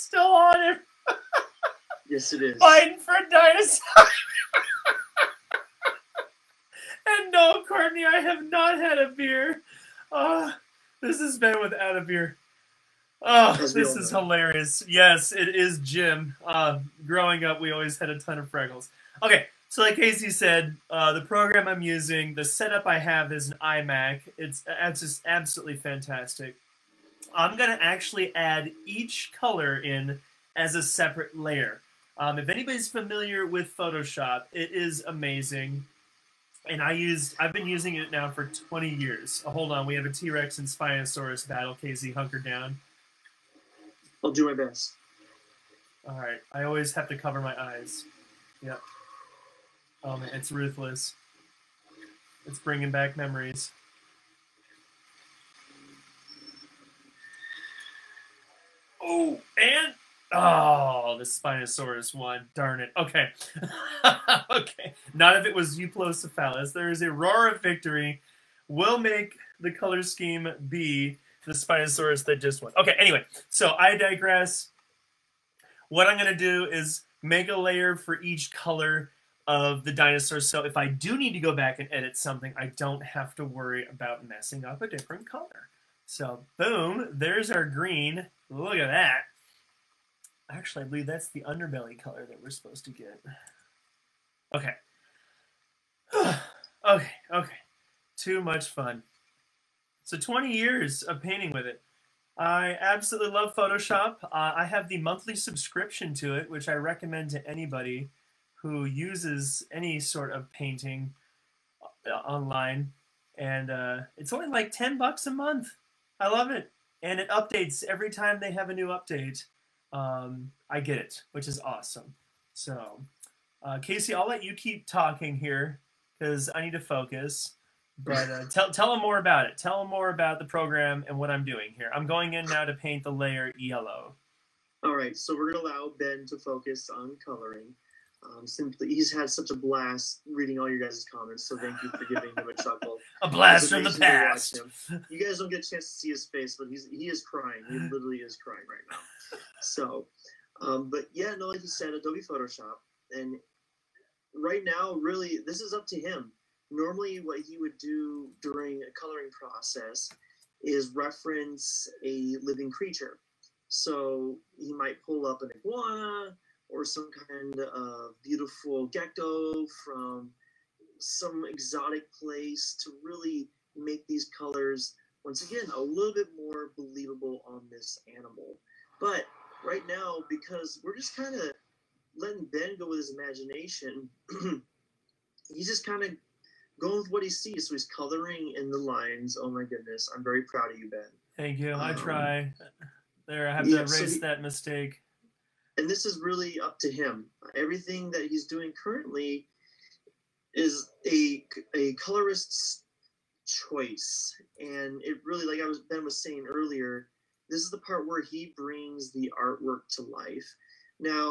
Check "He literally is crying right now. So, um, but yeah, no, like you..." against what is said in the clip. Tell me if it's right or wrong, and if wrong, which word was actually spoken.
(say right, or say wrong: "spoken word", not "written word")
right.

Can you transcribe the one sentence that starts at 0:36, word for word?
And I used, I've been using it now for 20 years.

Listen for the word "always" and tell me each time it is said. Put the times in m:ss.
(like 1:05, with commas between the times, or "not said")
0:17, 0:46.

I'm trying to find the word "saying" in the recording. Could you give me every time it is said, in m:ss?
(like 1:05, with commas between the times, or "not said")
3:26.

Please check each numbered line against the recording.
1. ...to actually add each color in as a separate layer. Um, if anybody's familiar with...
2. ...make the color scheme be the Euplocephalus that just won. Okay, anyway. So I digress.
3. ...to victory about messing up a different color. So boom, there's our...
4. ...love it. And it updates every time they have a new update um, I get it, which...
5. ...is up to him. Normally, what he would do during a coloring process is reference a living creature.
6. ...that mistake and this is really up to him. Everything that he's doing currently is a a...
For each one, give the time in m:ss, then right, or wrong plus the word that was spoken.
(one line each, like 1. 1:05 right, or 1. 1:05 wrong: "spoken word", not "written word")
1. 0:27 right
2. 1:08 wrong: "Spinosaurus", not "Euplocephalus"
3. 1:23 wrong: "worry", not "victory"
4. 1:56 right
5. 2:35 right
6. 3:14 right.